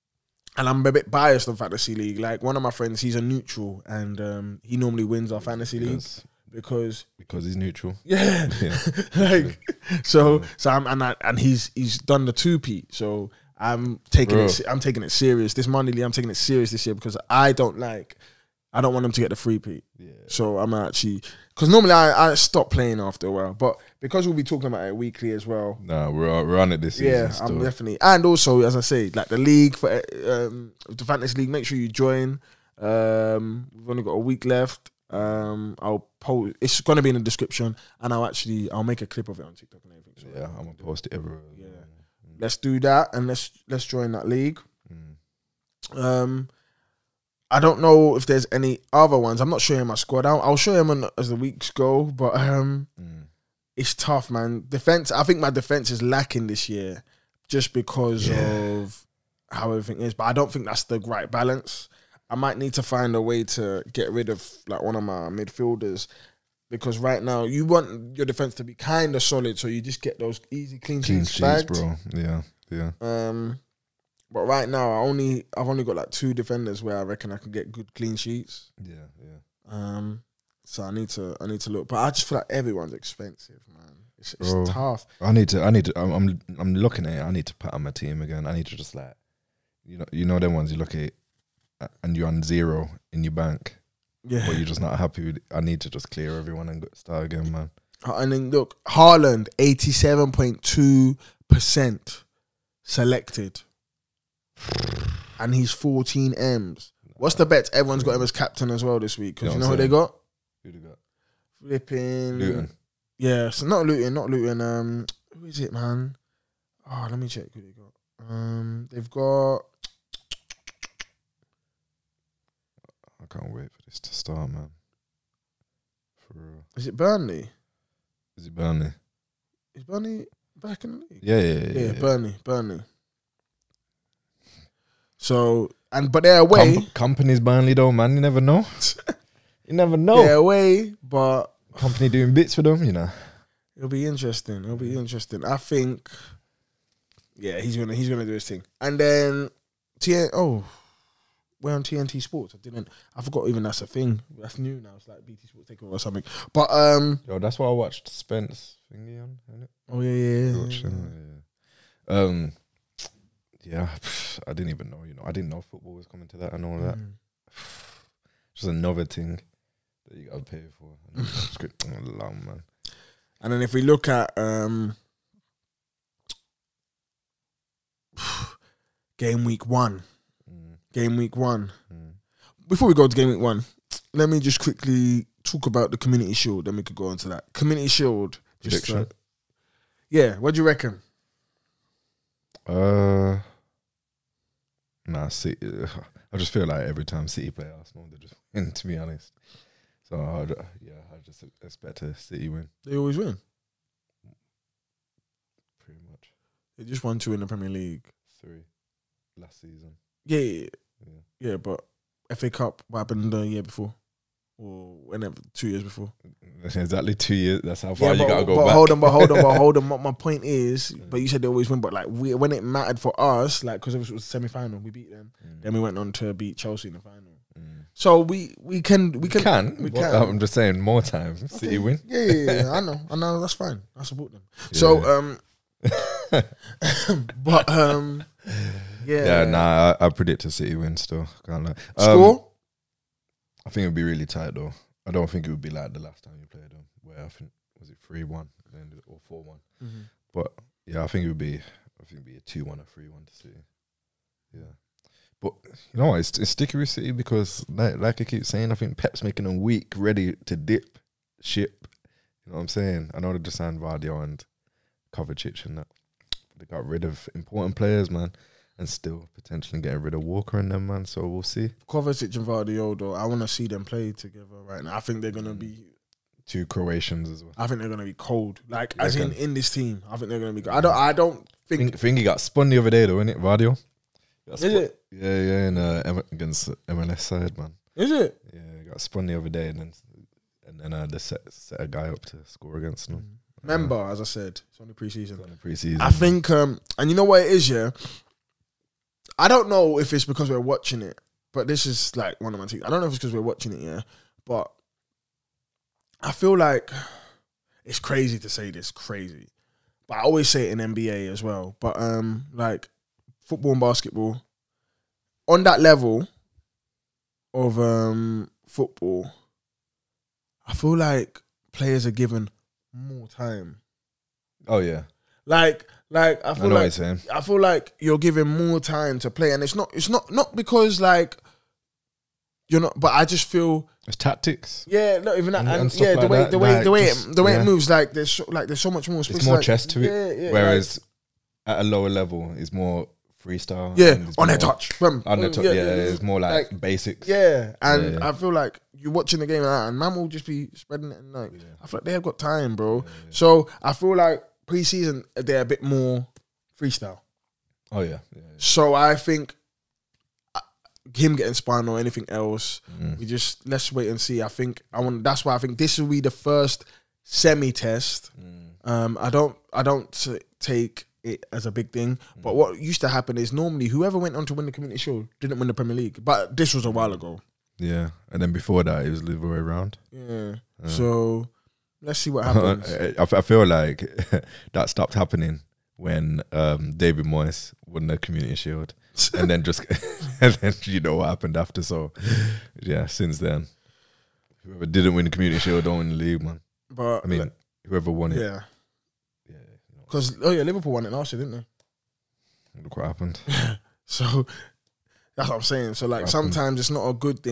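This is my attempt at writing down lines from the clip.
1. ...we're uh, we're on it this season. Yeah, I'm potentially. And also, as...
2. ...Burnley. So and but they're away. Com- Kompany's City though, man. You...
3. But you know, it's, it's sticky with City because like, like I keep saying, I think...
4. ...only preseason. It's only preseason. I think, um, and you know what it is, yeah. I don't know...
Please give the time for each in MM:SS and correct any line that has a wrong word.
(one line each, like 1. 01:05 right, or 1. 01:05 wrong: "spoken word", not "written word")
1. 00:26 wrong: "definitely", not "potentially"
2. 02:12 wrong: "Burnley", not "City"
3. 04:15 right
4. 04:54 right.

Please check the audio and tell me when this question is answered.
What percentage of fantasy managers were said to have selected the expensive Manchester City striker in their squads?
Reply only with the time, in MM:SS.
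01:39.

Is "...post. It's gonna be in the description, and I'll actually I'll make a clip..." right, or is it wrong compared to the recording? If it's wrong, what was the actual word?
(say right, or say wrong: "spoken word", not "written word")
right.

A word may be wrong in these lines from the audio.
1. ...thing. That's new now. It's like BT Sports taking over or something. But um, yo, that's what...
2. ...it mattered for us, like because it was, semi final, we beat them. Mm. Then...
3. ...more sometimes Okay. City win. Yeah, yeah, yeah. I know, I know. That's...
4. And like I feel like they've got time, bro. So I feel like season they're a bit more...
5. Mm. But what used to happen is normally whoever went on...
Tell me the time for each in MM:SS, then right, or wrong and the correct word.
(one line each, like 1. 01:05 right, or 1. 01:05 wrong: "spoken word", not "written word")
1. 02:33 right
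2. 03:42 right
3. 03:50 wrong: "times", not "sometimes"
4. 05:51 wrong: "preseason", not "season"
5. 06:12 right.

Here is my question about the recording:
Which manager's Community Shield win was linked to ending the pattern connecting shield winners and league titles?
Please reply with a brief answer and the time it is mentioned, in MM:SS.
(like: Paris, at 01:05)
David Moyes, at 06:26.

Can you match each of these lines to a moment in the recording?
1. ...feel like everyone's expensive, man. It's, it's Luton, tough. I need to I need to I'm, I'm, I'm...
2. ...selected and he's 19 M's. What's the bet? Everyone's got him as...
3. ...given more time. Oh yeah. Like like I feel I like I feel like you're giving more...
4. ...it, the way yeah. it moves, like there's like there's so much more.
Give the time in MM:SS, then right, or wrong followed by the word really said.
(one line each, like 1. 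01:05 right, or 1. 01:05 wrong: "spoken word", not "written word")
1. 01:22 wrong: "Bro", not "Luton"
2. 01:42 wrong: "14", not "19"
3. 05:22 right
4. 05:37 right.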